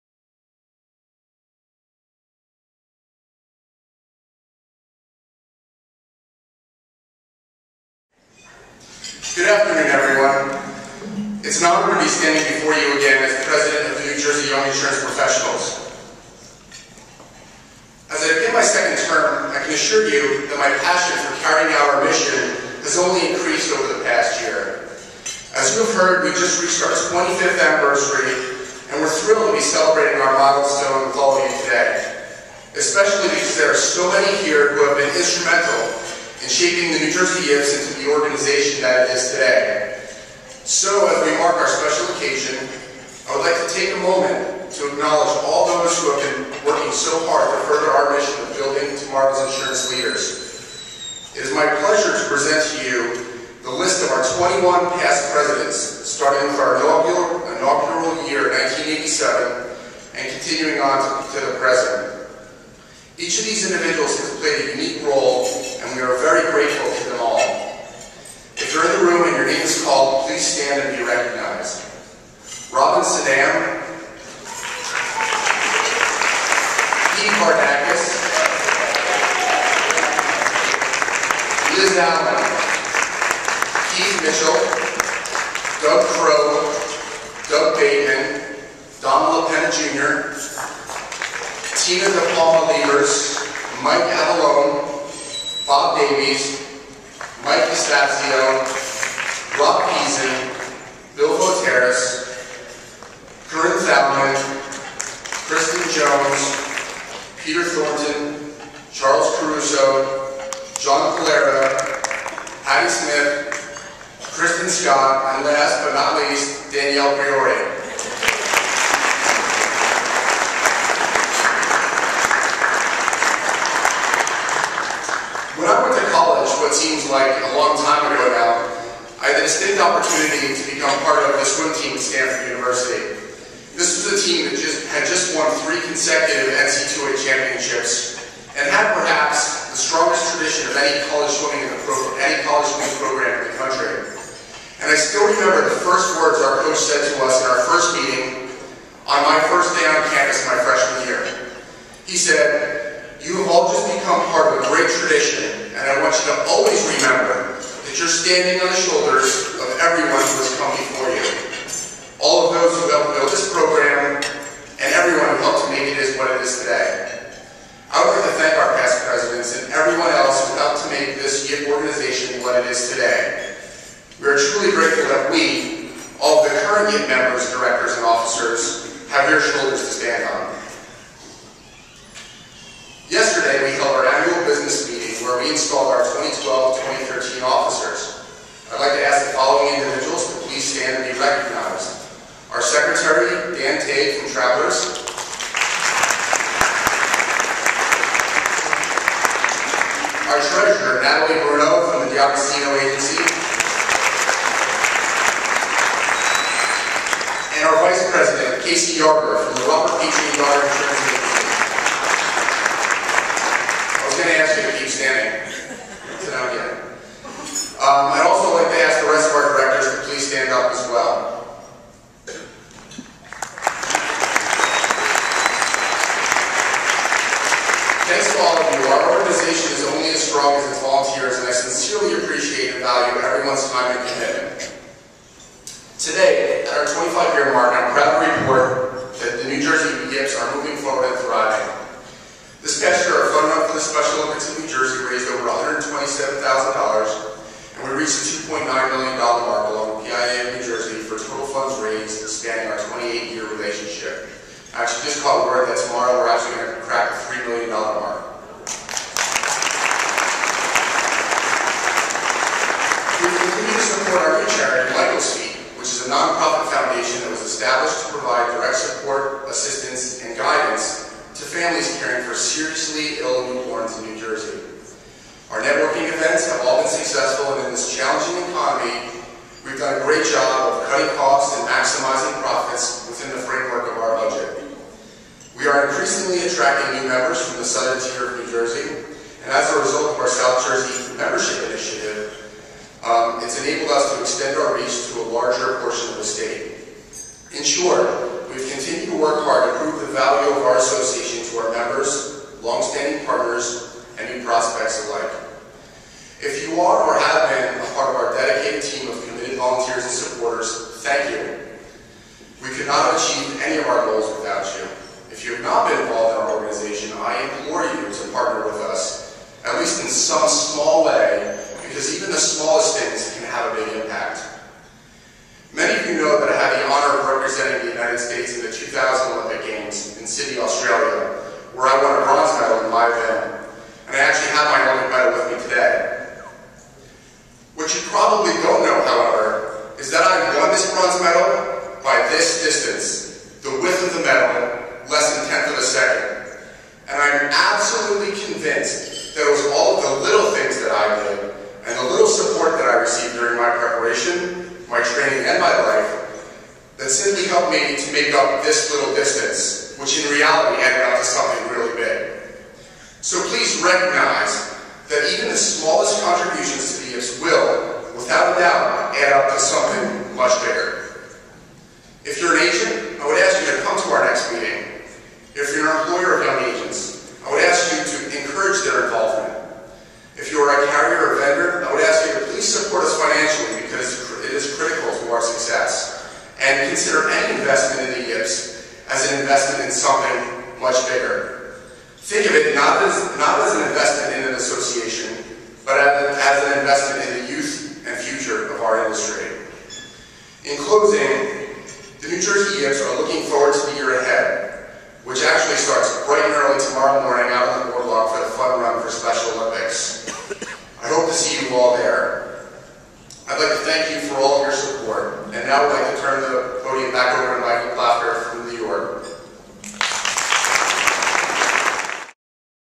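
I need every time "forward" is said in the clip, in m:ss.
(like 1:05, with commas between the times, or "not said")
4:00, 6:43.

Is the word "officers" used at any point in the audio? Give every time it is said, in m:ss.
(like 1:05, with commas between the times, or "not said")
2:58, 3:07.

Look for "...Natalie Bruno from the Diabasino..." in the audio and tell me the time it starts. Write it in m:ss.
3:21.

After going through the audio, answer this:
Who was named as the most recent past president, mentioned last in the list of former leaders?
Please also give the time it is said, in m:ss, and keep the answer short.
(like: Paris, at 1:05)
Danielle Priore, at 1:56.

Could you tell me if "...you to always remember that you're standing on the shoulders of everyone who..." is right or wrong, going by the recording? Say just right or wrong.
right.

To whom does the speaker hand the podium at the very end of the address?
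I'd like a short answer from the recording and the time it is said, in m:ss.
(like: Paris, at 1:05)
Michael Blatter, at 6:57.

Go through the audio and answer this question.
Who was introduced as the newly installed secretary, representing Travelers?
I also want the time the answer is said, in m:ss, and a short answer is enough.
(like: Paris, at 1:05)
Dan Tate, at 3:13.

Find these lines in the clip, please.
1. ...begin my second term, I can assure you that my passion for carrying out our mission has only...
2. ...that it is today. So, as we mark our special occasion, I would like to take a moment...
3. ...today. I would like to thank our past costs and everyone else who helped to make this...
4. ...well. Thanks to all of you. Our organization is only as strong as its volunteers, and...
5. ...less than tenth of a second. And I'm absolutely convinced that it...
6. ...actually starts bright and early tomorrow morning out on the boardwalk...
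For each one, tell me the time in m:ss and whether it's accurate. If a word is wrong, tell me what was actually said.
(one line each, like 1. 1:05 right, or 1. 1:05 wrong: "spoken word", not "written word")
1. 0:18 right
2. 0:38 right
3. 2:46 wrong: "presidents", not "costs"
4. 3:40 right
5. 5:45 right
6. 6:45 right.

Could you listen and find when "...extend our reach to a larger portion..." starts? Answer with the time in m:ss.
4:54.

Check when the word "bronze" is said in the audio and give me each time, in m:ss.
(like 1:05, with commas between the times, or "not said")
5:32, 5:40.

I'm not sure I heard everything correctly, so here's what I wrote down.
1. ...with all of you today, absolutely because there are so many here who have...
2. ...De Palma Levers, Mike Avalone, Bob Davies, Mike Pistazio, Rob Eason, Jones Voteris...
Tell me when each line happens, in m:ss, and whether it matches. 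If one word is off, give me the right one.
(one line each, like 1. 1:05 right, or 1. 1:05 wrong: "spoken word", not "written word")
1. 0:31 wrong: "especially", not "absolutely"
2. 1:32 wrong: "Bill", not "Jones".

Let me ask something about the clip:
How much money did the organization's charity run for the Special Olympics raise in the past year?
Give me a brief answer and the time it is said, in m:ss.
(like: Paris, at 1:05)
over $127,000, at 4:05.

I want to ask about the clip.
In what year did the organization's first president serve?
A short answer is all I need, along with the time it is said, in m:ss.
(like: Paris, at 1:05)
1987, at 0:58.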